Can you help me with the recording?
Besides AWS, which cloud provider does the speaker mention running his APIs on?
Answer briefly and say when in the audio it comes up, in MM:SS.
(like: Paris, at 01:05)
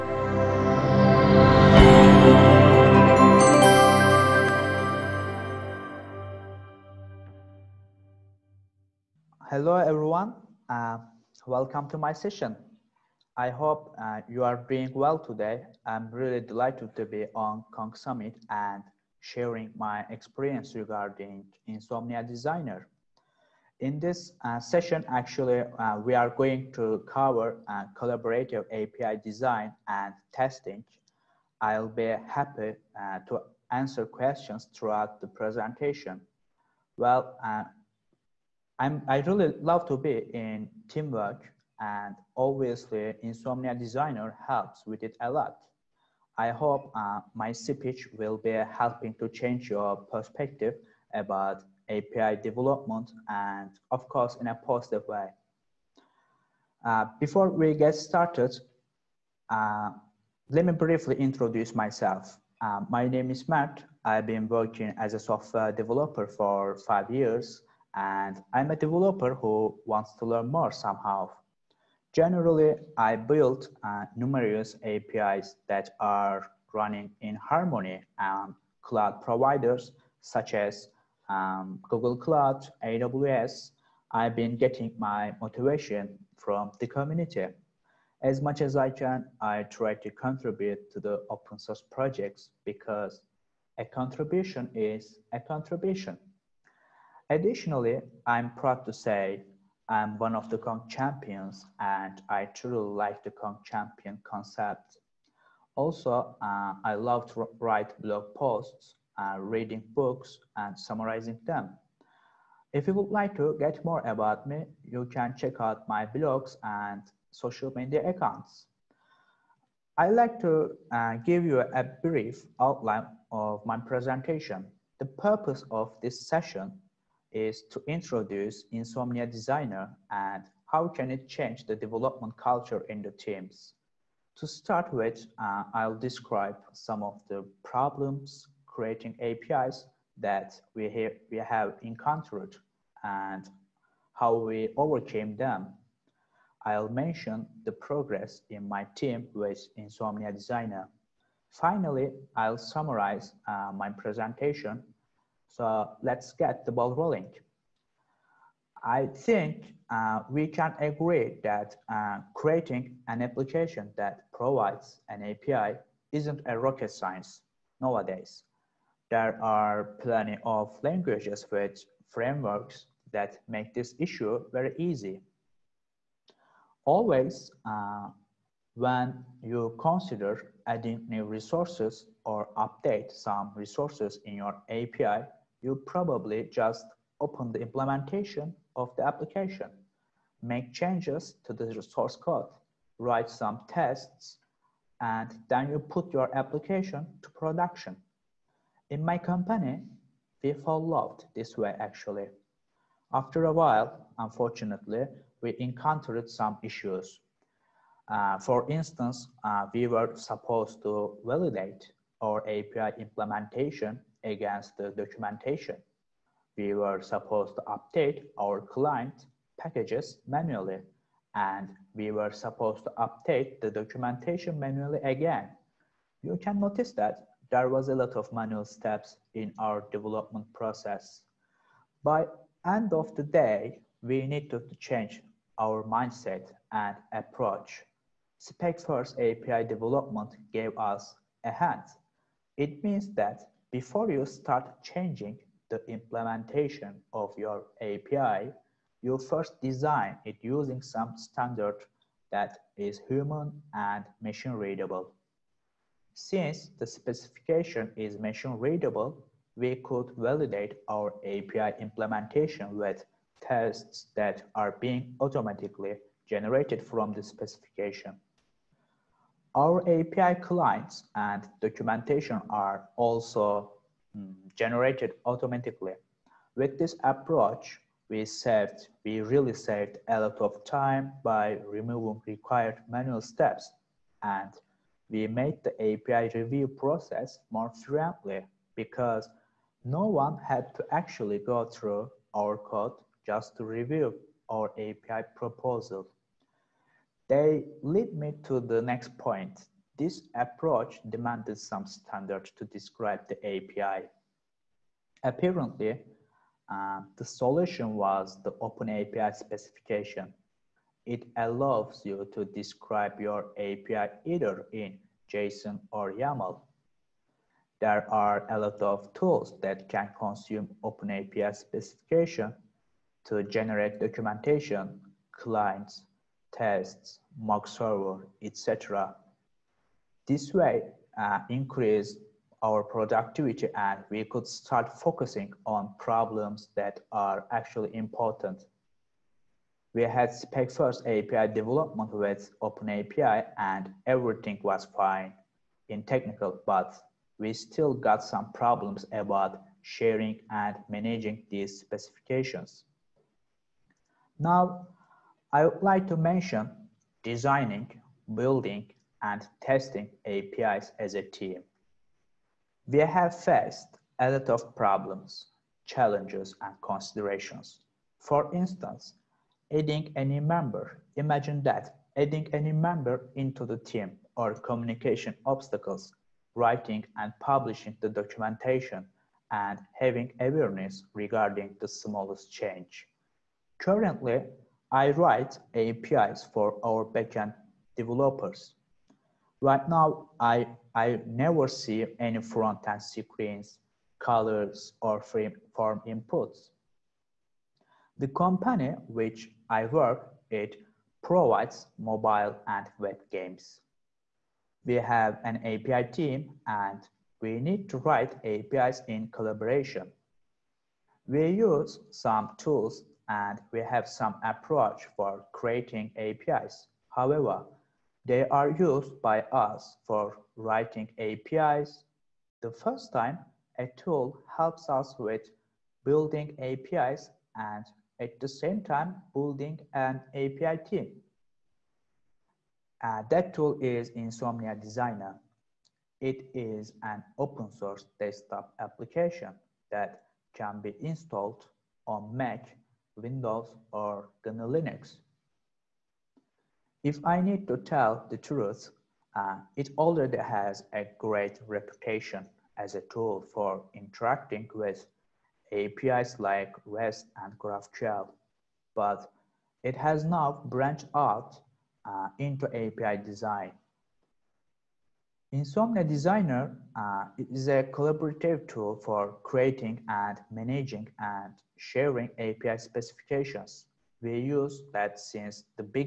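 Google Cloud, at 01:21.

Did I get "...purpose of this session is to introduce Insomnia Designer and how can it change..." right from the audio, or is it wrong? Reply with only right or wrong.
right.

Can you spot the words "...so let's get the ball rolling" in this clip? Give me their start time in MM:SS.
02:35.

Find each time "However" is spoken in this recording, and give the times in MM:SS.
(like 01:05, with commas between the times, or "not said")
06:57.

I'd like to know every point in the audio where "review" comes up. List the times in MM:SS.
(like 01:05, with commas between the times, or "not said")
04:46, 04:53.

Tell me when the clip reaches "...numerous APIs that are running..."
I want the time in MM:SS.
01:14.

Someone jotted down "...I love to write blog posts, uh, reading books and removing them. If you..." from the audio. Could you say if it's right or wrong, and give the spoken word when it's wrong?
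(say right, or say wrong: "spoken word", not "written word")
wrong: "summarizing", not "removing".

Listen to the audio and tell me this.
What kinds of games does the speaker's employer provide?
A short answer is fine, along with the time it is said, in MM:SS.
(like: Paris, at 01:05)
Mobile and web games, at 06:41.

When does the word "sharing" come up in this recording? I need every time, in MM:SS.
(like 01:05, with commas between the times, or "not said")
00:19, 05:49, 07:51.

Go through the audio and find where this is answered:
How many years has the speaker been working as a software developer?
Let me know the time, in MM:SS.
01:06.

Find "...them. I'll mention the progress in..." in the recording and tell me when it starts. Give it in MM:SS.
02:25.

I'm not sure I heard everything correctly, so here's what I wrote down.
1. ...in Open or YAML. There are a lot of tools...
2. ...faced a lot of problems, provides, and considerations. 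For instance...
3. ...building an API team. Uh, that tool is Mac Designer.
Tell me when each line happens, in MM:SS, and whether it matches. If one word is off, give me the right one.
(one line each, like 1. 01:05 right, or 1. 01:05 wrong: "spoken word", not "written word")
1. 05:14 wrong: "JSON", not "Open"
2. 06:03 wrong: "challenges", not "provides"
3. 07:09 wrong: "Insomnia", not "Mac".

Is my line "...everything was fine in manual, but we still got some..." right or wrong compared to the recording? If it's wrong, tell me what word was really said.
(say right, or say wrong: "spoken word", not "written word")
wrong: "technical", not "manual".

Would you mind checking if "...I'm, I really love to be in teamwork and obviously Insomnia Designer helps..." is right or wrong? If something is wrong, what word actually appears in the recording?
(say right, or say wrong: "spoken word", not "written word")
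right.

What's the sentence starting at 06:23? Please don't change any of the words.
Currently, I write APIs for our backend developers.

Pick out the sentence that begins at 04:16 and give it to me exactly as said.
Since the specification is machine readable, we could validate our API implementation with tests that are being automatically generated from the specification.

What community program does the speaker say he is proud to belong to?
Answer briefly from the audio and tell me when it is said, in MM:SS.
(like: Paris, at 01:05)
Kong champions, at 01:40.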